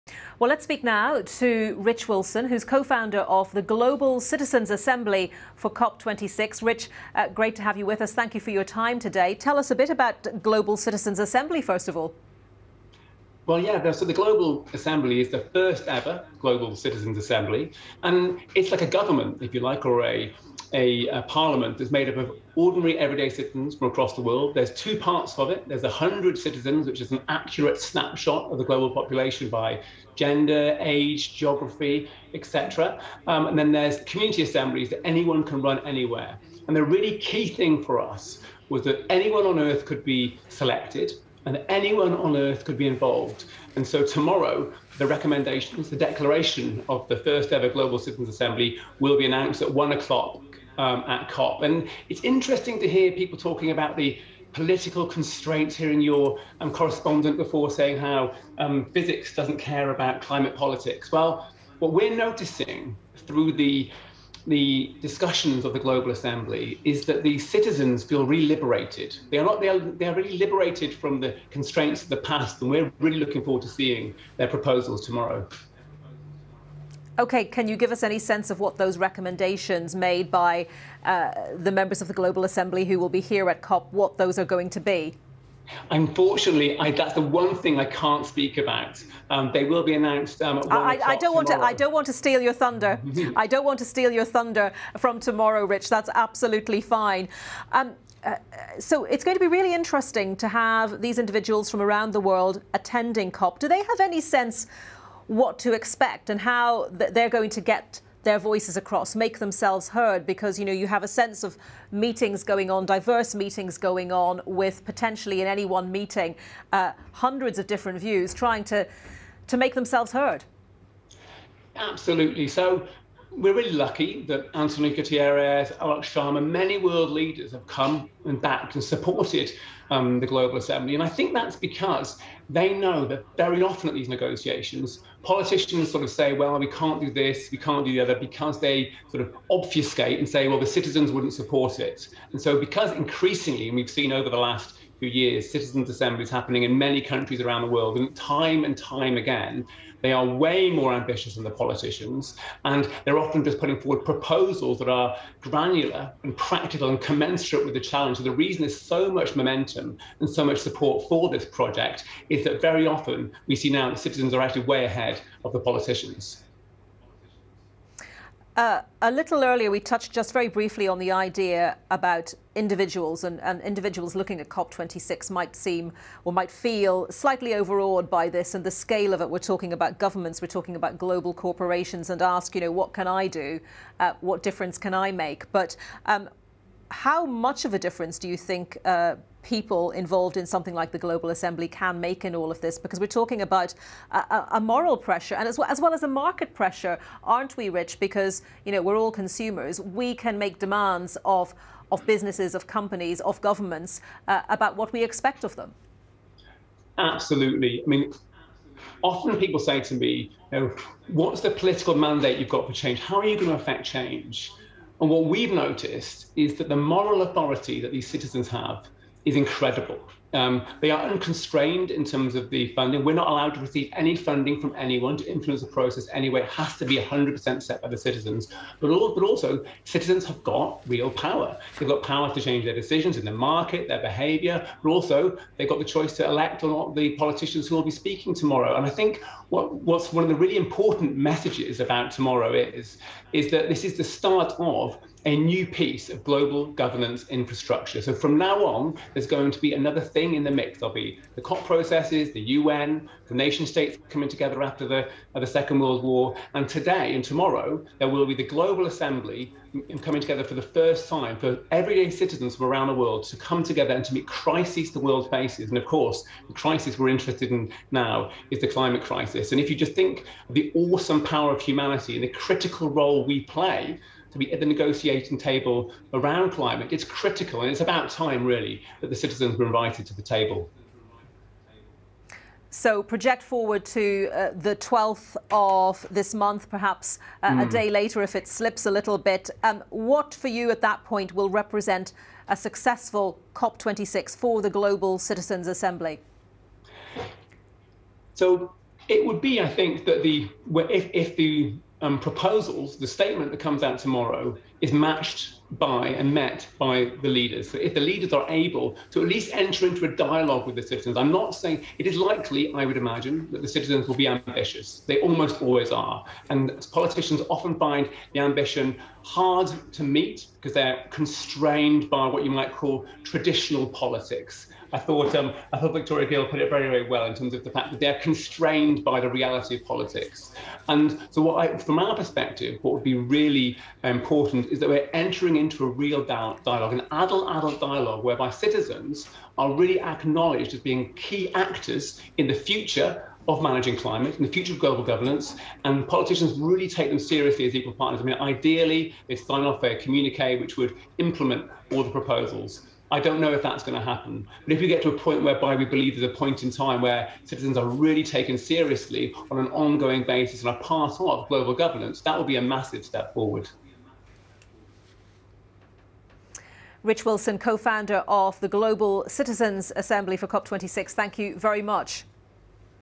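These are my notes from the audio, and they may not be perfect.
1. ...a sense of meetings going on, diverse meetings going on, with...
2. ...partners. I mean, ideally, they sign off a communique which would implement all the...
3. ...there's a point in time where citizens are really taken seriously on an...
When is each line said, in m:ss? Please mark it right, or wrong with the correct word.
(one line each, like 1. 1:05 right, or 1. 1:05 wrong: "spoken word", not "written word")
1. 1:51 right
2. 5:47 right
3. 5:56 right.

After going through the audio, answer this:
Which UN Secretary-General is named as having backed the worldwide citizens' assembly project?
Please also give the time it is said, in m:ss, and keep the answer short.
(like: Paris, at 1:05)
Antonio Guterres, at 2:04.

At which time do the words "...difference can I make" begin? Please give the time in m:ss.
3:04.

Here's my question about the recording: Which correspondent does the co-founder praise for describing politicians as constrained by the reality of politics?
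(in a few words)
Victoria Gill.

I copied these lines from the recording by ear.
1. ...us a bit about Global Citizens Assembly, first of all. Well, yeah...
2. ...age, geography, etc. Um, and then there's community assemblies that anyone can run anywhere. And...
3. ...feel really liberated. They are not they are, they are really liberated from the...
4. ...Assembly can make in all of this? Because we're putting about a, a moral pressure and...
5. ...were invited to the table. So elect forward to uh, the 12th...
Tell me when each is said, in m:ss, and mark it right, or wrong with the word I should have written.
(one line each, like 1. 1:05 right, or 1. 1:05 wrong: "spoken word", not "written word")
1. 0:09 right
2. 0:30 right
3. 1:08 right
4. 3:11 wrong: "talking", not "putting"
5. 4:39 wrong: "project", not "elect".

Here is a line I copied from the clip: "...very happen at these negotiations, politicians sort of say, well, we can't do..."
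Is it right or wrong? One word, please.
wrong.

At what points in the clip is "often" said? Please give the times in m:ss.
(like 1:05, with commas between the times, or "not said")
2:13, 2:33, 2:42, 3:29, 5:17.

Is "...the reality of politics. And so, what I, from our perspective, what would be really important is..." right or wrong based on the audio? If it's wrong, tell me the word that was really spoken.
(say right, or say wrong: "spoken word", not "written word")
right.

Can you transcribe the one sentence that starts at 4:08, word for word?
So from now on, there's going to be another thing in the mix.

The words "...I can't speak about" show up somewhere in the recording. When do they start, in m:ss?
1:27.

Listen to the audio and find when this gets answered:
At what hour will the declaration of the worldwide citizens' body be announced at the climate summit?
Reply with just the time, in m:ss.
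0:49.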